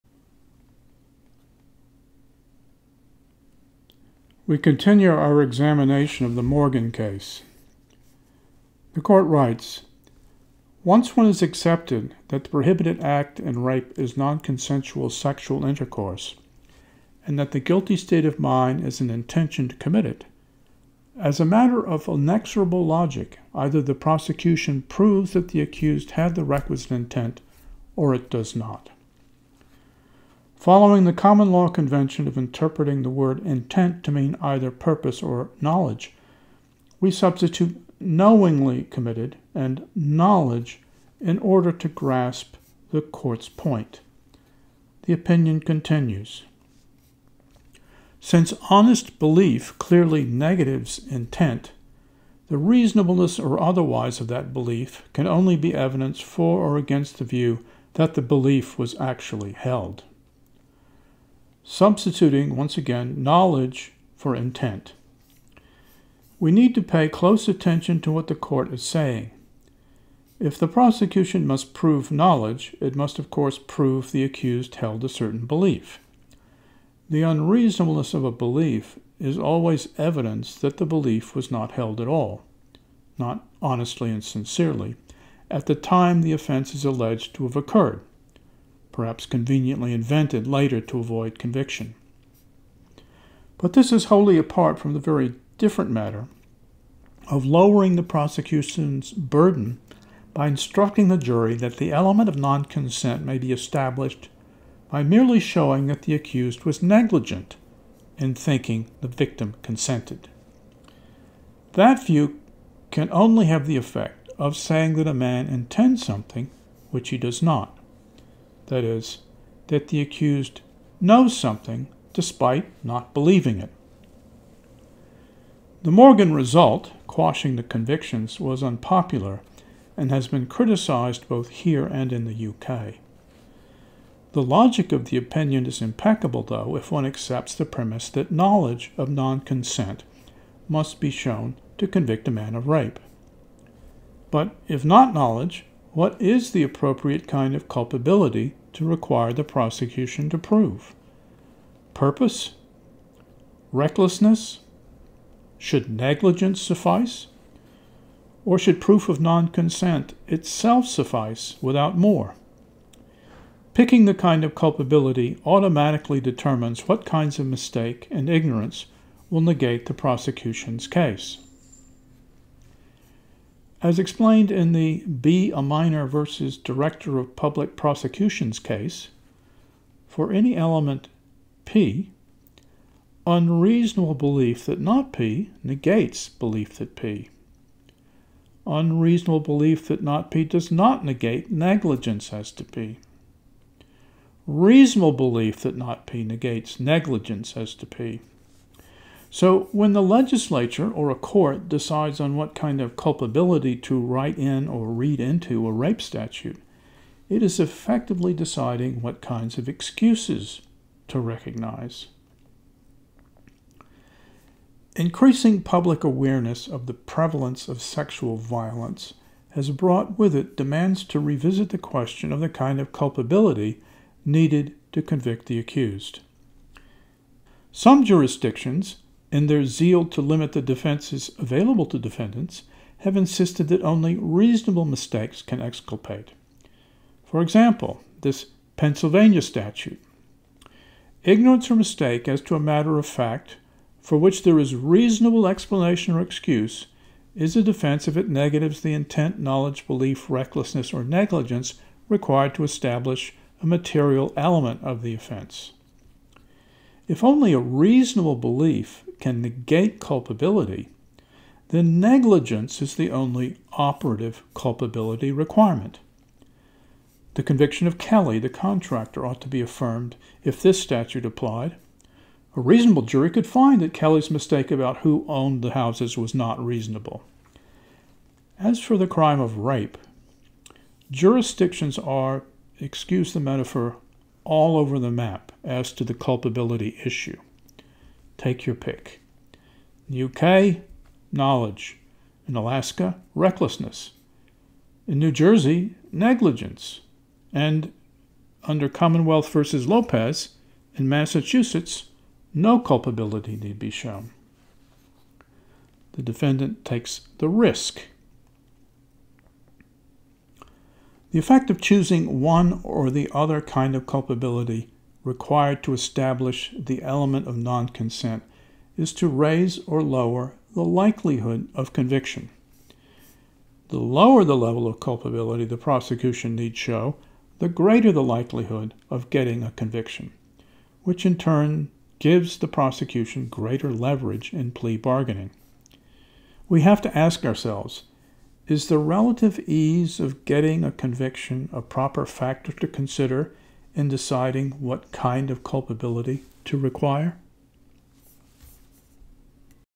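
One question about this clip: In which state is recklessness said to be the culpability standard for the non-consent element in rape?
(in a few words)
Alaska.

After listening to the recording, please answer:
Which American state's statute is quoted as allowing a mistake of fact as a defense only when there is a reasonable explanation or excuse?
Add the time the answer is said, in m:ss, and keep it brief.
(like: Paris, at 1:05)
Pennsylvania, at 3:58.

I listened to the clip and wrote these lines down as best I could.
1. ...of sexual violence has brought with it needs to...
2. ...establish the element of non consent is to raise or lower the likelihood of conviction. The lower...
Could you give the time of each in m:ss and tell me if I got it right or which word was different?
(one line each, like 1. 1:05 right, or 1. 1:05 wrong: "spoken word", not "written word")
1. 3:37 wrong: "demands", not "needs"
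2. 5:15 right.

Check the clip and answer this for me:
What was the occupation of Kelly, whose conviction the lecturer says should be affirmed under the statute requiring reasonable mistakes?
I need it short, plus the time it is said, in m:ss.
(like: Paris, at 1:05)
contractor, at 4:28.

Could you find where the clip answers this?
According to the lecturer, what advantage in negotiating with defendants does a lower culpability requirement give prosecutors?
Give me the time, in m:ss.
5:34.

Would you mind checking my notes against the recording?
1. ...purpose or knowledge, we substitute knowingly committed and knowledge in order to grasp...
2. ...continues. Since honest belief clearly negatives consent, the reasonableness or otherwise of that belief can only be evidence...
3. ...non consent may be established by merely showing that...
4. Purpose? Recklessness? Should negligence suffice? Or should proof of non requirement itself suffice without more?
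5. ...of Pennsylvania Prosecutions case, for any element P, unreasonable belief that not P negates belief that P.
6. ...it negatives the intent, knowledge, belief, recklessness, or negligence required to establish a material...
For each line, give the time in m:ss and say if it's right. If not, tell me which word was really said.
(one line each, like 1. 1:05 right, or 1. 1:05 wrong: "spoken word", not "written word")
1. 0:34 right
2. 0:45 wrong: "intent", not "consent"
3. 1:42 right
4. 2:31 wrong: "consent", not "requirement"
5. 2:57 wrong: "Public", not "Pennsylvania"
6. 4:08 right.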